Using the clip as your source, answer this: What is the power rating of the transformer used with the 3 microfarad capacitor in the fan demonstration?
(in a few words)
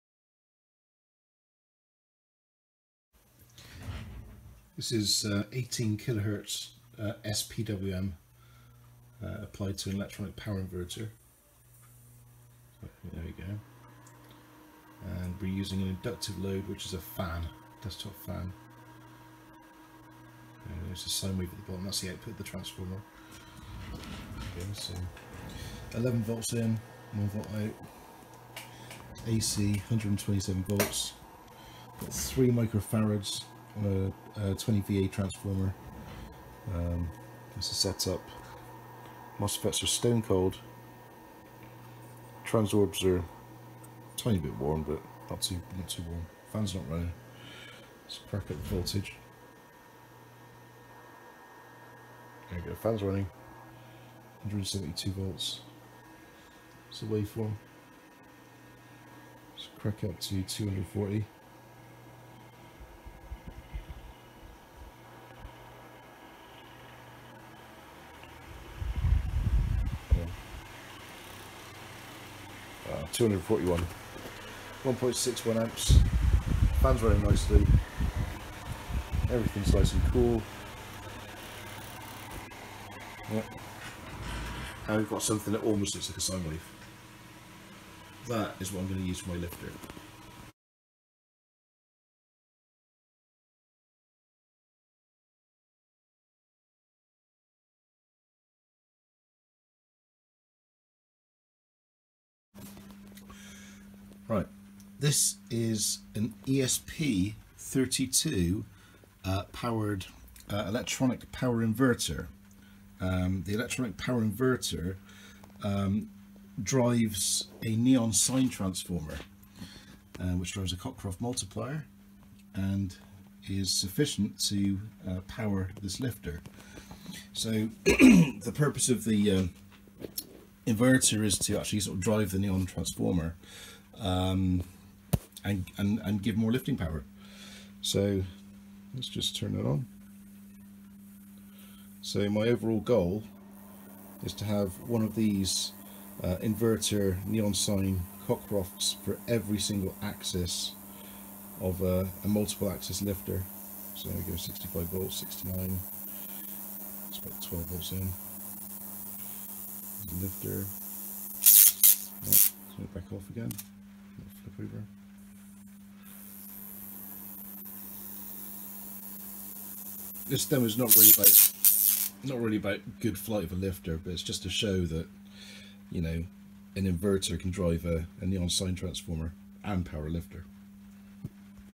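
20VA.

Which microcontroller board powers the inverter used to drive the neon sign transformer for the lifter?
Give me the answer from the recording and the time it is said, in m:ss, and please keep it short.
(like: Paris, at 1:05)
ESP32, at 1:46.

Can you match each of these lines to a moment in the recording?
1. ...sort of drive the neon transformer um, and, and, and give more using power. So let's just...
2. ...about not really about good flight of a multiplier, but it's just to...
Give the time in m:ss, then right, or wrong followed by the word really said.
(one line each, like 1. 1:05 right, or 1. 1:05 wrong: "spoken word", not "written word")
1. 2:11 wrong: "lifting", not "using"
2. 2:51 wrong: "lifter", not "multiplier".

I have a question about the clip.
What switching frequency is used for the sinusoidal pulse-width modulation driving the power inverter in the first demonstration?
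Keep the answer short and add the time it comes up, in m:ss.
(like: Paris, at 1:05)
18 kHz, at 0:05.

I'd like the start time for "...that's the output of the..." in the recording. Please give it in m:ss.
0:21.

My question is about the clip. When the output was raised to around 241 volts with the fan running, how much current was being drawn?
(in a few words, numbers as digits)
1.61 amps.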